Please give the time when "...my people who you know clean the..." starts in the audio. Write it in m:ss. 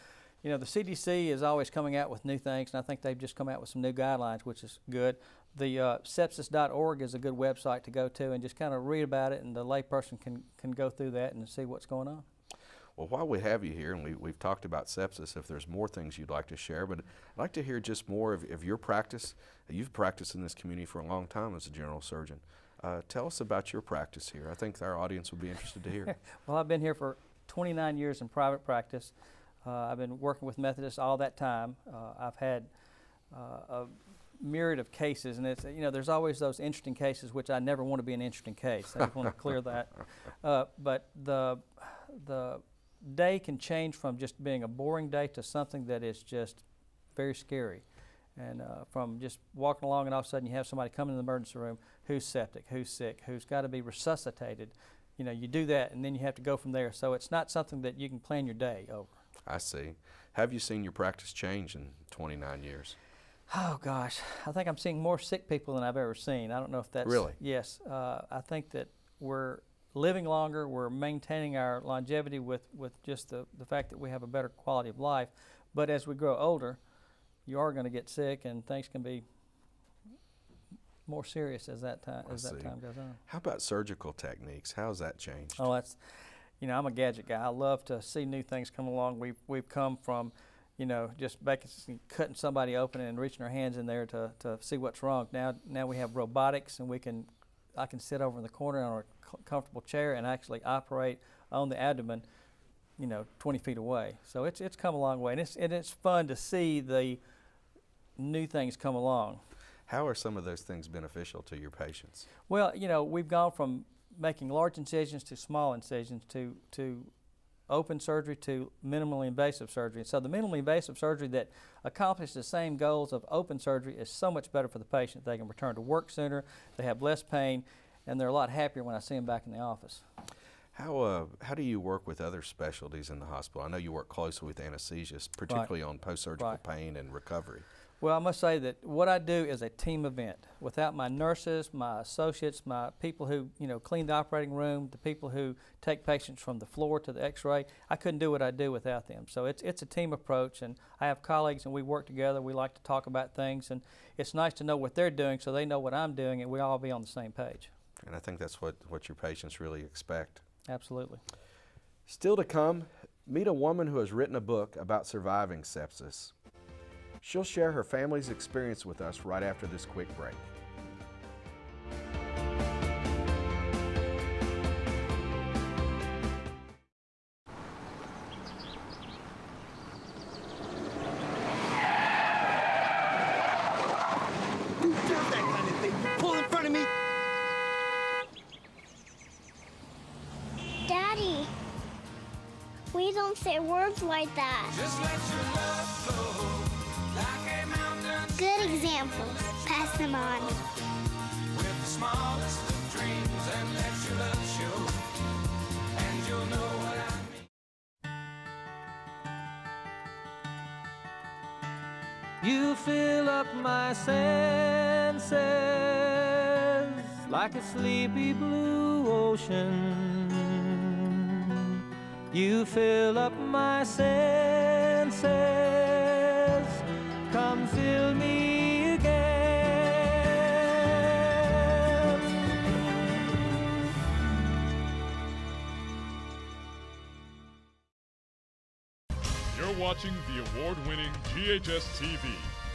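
2:22.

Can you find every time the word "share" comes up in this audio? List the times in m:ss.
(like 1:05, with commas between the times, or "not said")
0:16, 2:47.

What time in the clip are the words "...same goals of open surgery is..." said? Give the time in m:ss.
2:02.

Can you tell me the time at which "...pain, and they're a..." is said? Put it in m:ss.
2:07.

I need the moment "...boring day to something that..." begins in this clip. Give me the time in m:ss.
0:44.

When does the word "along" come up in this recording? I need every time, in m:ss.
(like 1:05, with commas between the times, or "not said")
0:49, 1:28, 1:48.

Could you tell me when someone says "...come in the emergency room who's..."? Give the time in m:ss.
0:50.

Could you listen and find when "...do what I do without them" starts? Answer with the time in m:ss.
2:28.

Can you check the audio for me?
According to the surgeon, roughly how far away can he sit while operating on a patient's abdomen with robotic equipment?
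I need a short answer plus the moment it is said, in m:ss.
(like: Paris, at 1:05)
20 feet, at 1:43.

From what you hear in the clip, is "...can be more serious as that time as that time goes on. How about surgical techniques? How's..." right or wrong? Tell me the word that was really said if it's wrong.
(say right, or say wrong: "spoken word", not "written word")
right.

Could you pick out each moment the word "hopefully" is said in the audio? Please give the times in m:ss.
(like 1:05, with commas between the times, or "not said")
not said.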